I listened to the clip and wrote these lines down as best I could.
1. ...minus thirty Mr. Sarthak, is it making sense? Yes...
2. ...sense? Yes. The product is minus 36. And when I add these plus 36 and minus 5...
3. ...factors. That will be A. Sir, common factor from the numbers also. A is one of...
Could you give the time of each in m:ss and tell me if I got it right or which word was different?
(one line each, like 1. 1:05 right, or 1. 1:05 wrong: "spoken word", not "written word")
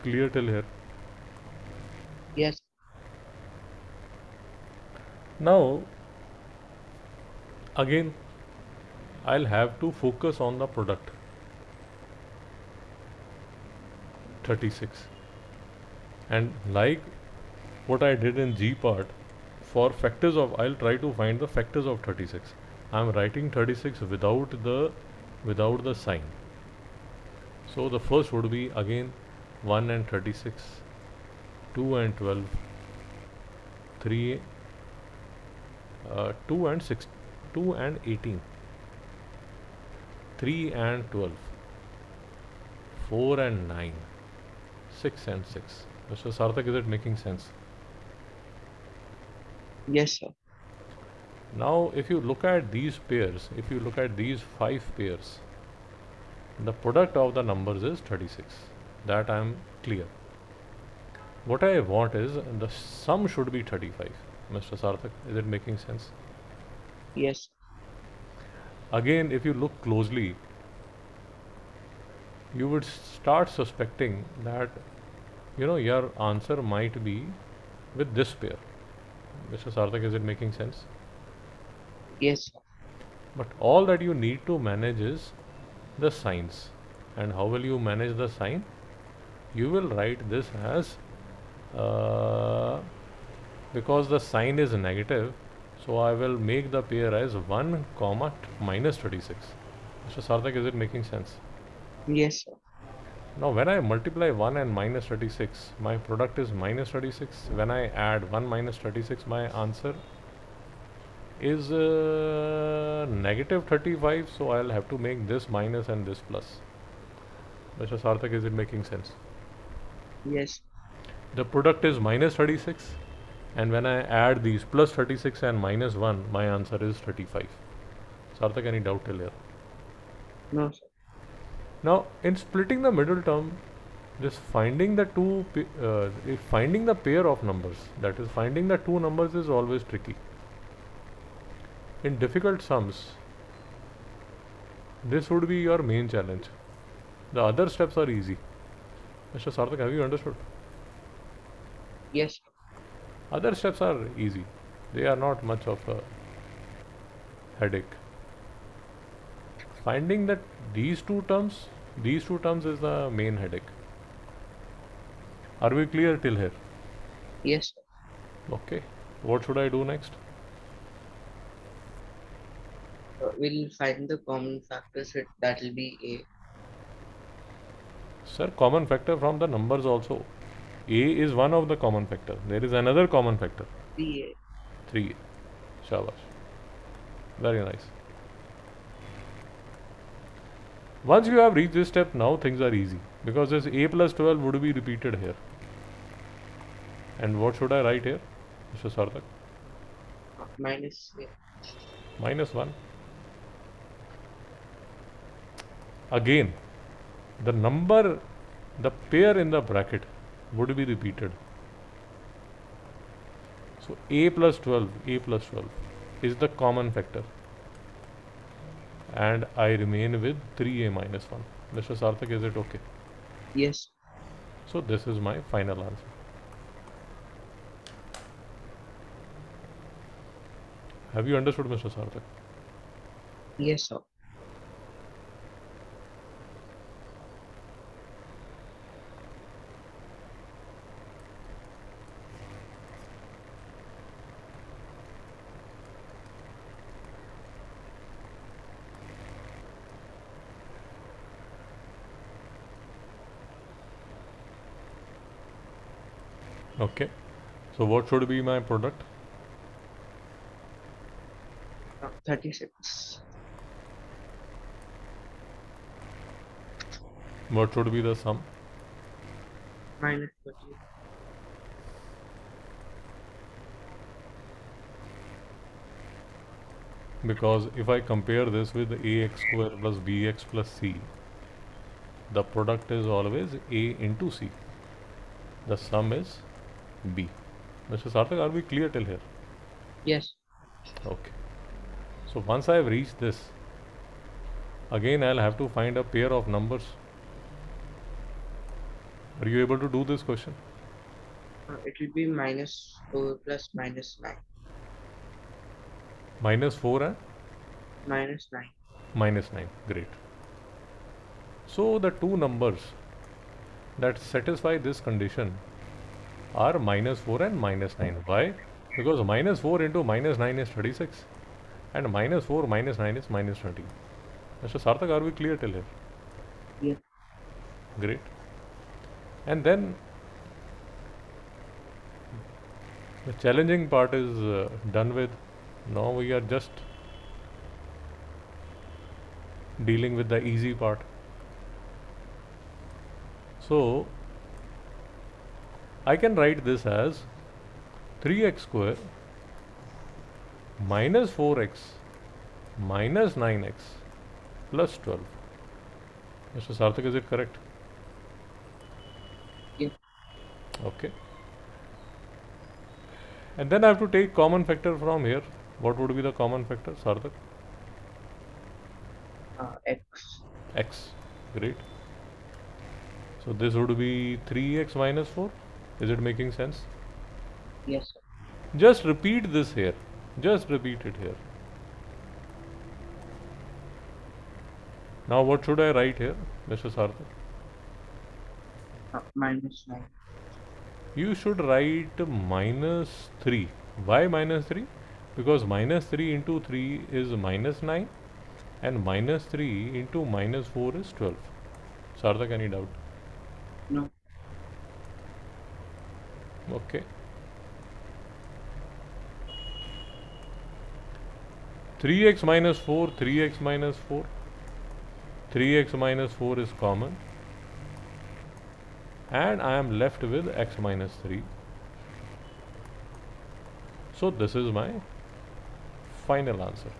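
1. 1:38 right
2. 1:58 wrong: "1", not "5"
3. 2:54 right.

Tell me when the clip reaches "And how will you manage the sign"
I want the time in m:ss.
1:27.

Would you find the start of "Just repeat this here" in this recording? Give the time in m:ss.
6:18.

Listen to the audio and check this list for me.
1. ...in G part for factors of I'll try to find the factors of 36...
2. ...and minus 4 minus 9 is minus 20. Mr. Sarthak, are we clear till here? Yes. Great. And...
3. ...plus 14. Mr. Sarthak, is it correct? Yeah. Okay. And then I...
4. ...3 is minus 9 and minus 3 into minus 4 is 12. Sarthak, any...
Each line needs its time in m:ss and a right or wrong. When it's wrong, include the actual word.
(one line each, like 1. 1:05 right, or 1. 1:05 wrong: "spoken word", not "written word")
1. 0:18 right
2. 5:21 right
3. 5:54 wrong: "12", not "14"
4. 6:36 right.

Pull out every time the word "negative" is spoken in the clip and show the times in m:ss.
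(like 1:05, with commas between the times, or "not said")
1:34, 1:53.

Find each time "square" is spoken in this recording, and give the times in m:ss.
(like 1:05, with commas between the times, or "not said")
4:39, 5:48.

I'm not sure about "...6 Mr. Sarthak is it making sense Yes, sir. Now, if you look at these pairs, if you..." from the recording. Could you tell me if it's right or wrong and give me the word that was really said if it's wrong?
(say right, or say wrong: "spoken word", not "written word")
right.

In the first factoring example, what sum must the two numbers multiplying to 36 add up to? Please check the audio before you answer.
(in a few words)
35.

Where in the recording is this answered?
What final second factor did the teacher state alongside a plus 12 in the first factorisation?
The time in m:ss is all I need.
3:40.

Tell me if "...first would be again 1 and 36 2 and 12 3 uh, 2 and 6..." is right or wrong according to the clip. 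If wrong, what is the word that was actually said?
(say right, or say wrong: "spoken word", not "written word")
right.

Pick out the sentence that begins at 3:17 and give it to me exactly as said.
And what should I write here, Mr.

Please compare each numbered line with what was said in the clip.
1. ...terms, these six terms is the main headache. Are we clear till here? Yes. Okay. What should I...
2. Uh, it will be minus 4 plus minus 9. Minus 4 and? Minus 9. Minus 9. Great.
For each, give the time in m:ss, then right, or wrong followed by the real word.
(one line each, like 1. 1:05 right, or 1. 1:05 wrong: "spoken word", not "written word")
1. 2:41 wrong: "two", not "six"
2. 5:01 right.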